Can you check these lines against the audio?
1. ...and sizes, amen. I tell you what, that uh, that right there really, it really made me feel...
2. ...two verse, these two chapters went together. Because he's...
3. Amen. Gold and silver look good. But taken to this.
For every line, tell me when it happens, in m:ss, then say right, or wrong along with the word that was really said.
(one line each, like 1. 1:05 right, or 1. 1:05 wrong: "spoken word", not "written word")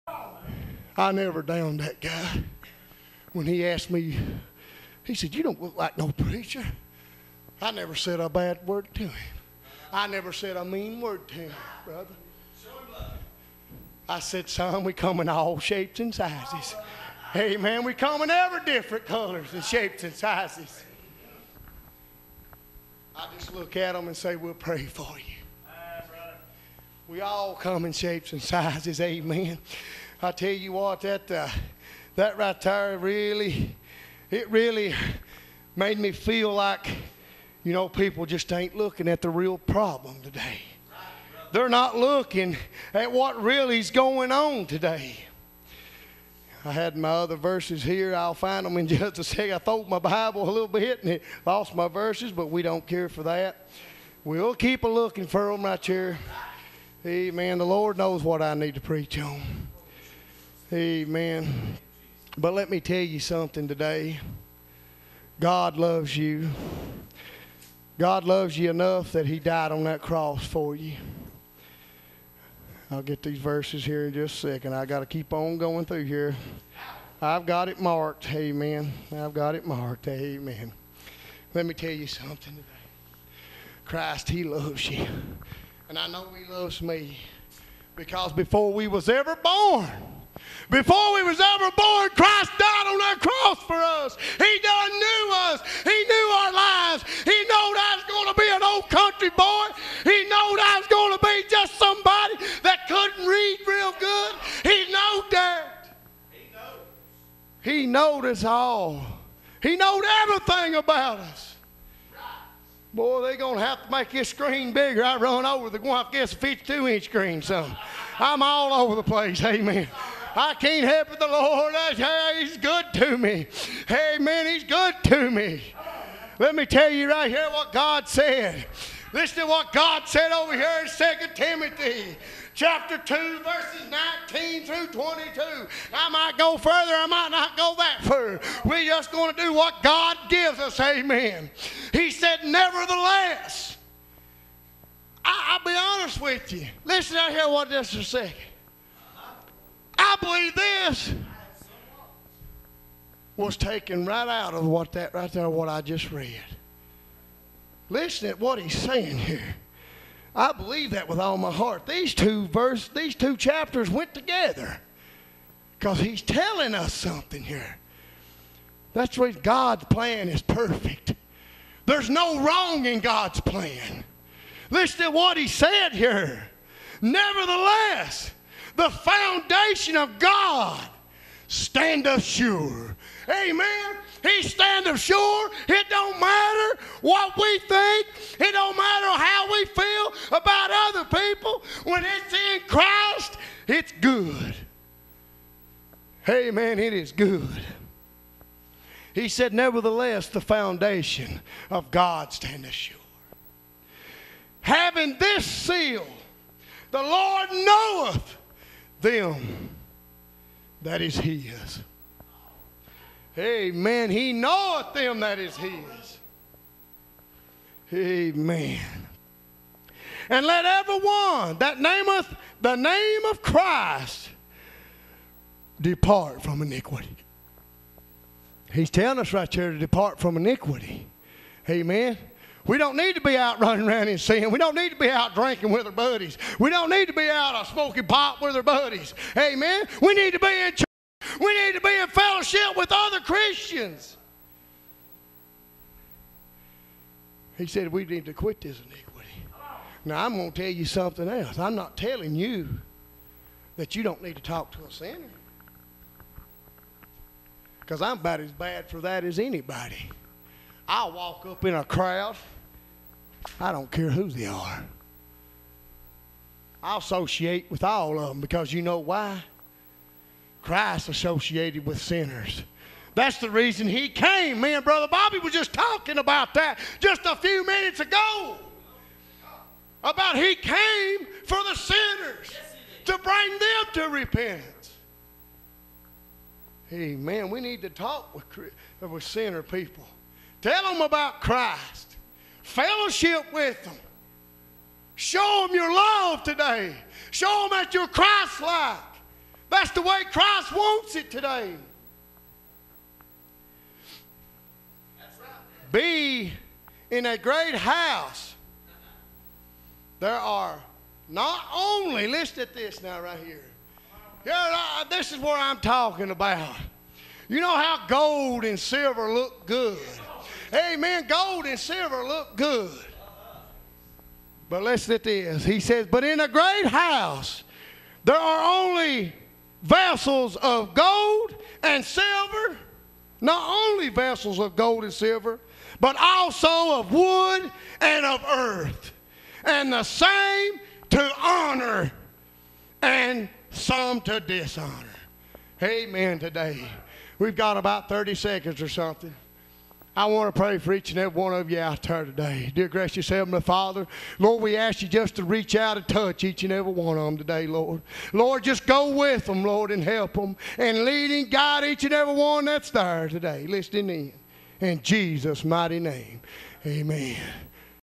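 1. 0:28 right
2. 2:42 right
3. 5:20 wrong: "listen", not "taken".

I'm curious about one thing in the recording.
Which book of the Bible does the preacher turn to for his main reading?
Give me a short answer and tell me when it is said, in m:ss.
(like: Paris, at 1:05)
2 Timothy, at 2:10.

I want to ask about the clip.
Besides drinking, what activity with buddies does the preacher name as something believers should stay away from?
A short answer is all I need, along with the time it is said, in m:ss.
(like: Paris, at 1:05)
smoking pot, at 3:57.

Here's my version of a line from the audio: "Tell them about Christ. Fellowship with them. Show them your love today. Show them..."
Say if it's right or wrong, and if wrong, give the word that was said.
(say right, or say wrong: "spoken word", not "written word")
right.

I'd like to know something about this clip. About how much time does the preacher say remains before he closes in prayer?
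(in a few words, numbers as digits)
30 seconds.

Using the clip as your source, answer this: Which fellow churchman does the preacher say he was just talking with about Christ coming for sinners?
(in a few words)
Brother Bobby.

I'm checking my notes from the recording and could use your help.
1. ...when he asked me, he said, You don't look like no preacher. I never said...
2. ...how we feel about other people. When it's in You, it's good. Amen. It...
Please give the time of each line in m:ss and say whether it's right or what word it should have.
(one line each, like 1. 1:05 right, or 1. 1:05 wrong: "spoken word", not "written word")
1. 0:03 right
2. 3:09 wrong: "Christ", not "You".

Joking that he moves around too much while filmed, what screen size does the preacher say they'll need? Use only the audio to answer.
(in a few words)
52 inch.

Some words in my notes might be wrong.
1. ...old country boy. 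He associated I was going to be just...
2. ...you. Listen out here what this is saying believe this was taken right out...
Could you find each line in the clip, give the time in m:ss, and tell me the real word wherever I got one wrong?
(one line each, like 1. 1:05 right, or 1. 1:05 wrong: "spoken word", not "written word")
1. 1:38 wrong: "knowed", not "associated"
2. 2:26 right.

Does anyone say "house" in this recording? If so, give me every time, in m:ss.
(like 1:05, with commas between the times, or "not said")
5:07, 5:26.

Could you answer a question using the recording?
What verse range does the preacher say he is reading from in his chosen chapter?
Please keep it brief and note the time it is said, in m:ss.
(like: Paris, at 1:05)
19 through 22, at 2:13.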